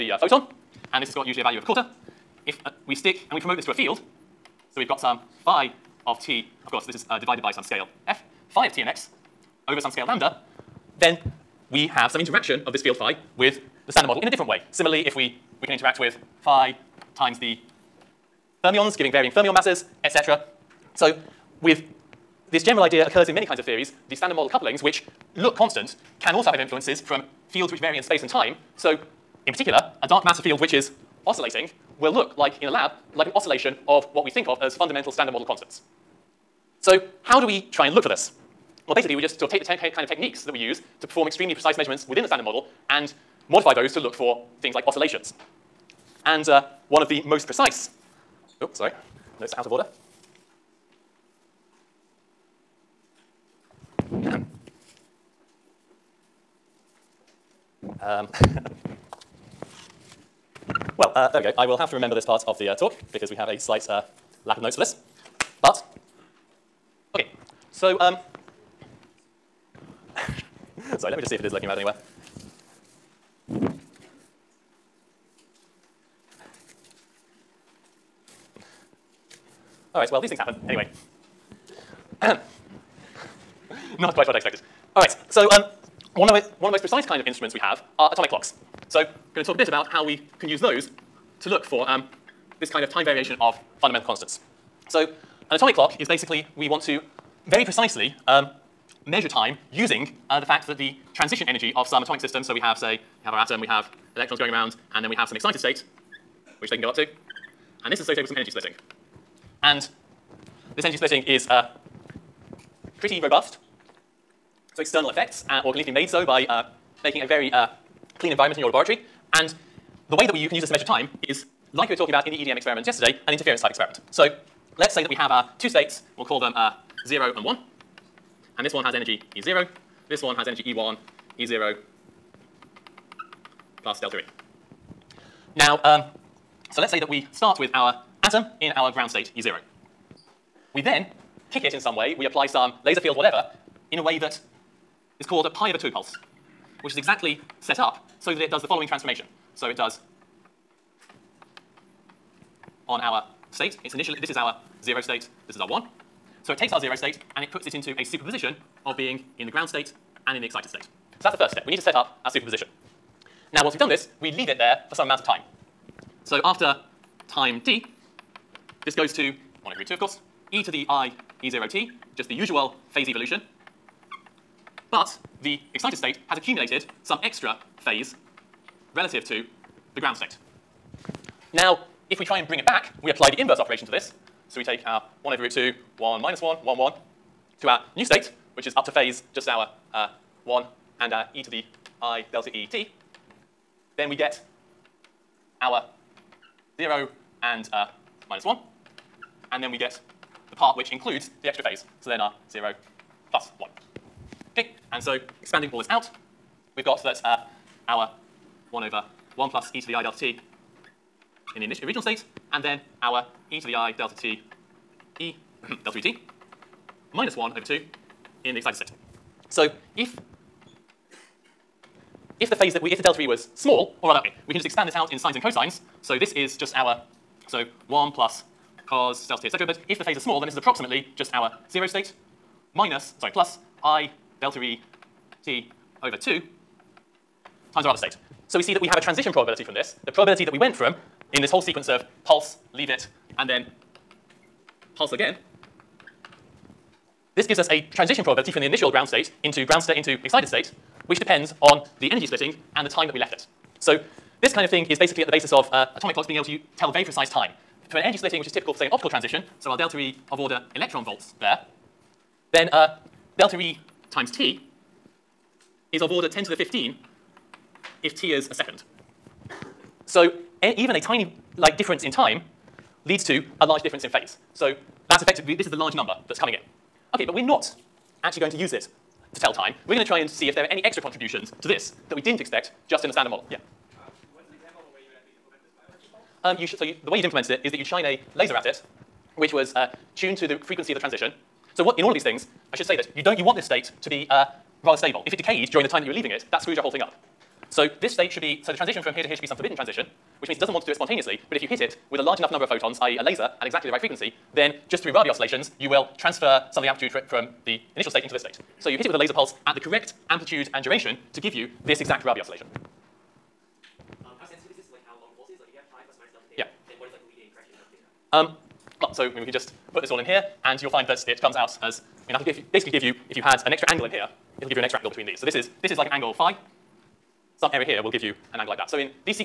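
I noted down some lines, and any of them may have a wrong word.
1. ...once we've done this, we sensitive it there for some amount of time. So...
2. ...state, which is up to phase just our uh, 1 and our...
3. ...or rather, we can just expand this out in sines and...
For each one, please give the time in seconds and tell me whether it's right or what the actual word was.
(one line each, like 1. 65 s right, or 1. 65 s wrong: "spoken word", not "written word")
1. 163 s wrong: "leave", not "sensitive"
2. 188 s right
3. 224 s right.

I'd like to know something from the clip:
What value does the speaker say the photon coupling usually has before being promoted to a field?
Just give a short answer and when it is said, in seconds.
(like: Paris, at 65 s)
a quarter, at 1 s.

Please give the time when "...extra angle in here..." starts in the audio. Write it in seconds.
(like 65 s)
323 s.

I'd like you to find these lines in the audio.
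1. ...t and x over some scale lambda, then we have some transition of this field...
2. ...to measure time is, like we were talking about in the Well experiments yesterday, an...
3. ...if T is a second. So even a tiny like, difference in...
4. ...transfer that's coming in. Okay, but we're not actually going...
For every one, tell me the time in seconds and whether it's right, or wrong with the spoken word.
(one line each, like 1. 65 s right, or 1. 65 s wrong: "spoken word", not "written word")
1. 8 s wrong: "interaction", not "transition"
2. 120 s wrong: "EDM", not "Well"
3. 268 s right
4. 275 s wrong: "number", not "transfer".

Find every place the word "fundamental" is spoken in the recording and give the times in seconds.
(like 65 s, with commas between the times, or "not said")
34 s, 93 s.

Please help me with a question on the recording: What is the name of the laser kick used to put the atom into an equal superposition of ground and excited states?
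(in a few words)
pi over 2 pulse.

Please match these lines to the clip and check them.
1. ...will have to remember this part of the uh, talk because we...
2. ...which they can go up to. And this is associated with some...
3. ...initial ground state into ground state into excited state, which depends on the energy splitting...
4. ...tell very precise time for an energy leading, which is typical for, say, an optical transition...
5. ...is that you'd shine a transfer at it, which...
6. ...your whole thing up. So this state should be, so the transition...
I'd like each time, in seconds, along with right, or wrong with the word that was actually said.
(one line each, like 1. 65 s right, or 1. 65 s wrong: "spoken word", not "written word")
1. 61 s right
2. 106 s right
3. 248 s right
4. 256 s wrong: "splitting", not "leading"
5. 287 s wrong: "laser", not "transfer"
6. 296 s right.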